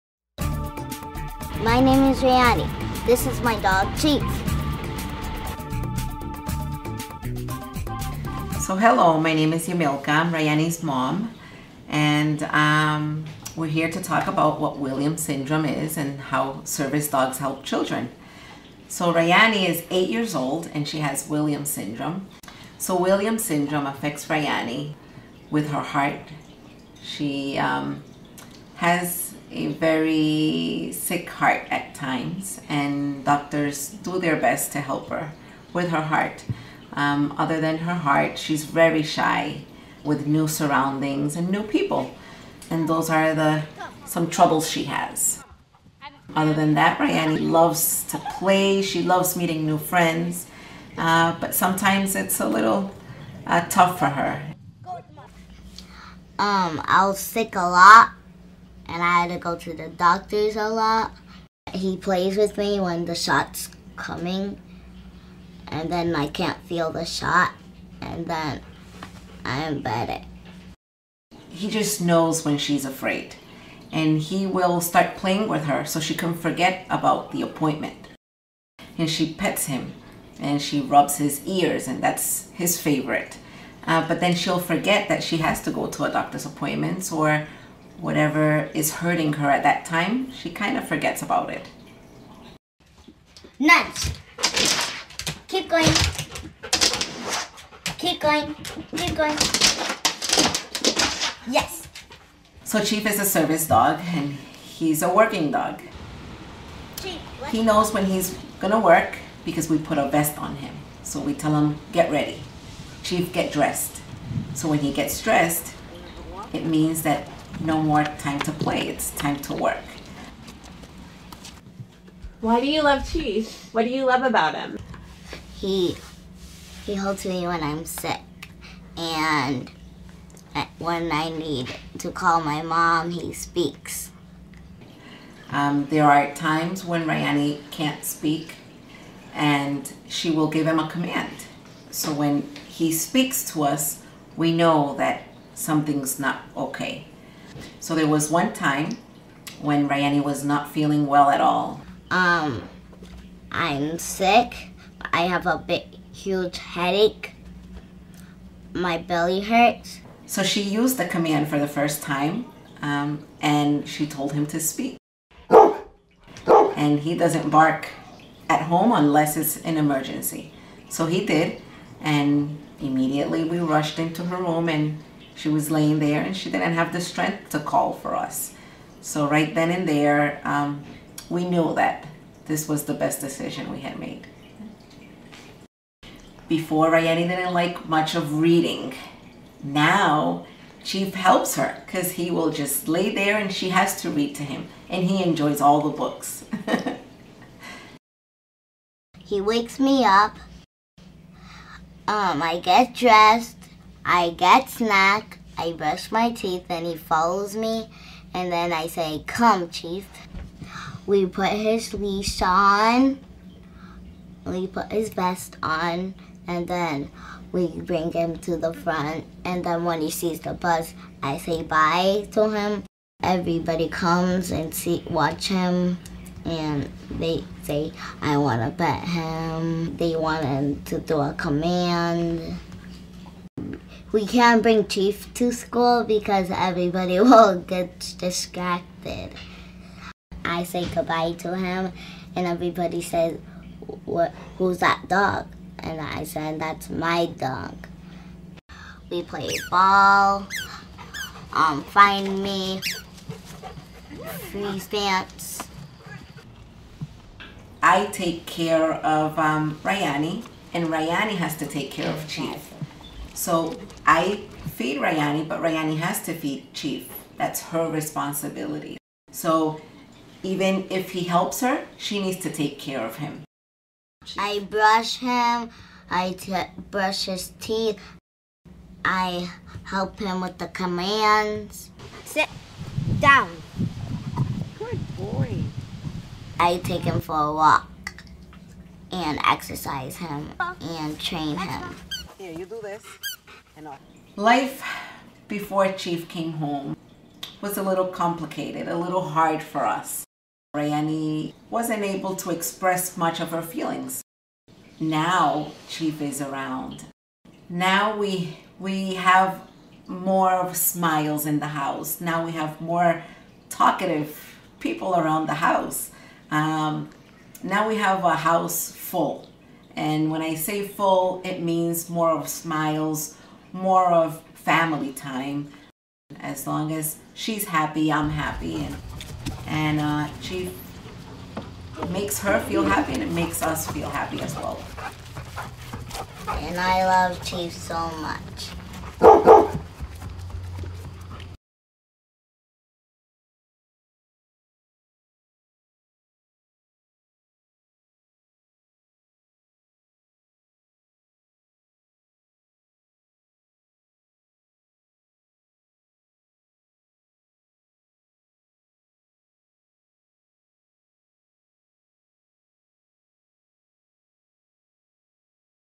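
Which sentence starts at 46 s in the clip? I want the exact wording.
Other than that, Rayanie loves to play.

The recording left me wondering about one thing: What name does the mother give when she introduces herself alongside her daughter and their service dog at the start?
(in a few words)
Yamilka.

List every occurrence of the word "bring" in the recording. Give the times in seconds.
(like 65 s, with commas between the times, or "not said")
217 s, 234 s.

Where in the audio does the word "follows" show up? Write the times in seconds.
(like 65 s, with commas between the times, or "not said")
206 s.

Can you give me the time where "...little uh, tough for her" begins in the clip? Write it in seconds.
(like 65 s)
52 s.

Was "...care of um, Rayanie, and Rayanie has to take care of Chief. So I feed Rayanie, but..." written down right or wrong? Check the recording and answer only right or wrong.
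right.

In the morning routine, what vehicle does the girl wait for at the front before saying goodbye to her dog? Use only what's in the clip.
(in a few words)
The bus.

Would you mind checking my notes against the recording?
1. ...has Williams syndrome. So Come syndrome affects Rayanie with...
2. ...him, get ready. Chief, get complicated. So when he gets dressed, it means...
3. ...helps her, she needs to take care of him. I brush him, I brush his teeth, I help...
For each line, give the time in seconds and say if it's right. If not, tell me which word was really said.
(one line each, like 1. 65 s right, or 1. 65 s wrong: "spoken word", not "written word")
1. 21 s wrong: "Williams", not "Come"
2. 111 s wrong: "dressed", not "complicated"
3. 271 s right.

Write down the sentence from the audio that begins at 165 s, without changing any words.
And he doesn't bark at home unless it's an emergency.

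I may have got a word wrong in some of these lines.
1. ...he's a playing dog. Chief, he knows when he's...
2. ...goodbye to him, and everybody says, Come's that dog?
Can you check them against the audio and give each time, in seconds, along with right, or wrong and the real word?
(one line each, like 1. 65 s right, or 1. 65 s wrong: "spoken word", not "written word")
1. 104 s wrong: "working", not "playing"
2. 240 s wrong: "Who", not "Come".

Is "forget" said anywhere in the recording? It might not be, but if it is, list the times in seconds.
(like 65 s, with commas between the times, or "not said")
76 s, 84 s, 90 s.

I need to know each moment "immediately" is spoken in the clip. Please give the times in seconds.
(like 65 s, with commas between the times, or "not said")
172 s.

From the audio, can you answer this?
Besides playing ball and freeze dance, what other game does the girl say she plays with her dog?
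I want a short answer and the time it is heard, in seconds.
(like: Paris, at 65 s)
Find me, at 251 s.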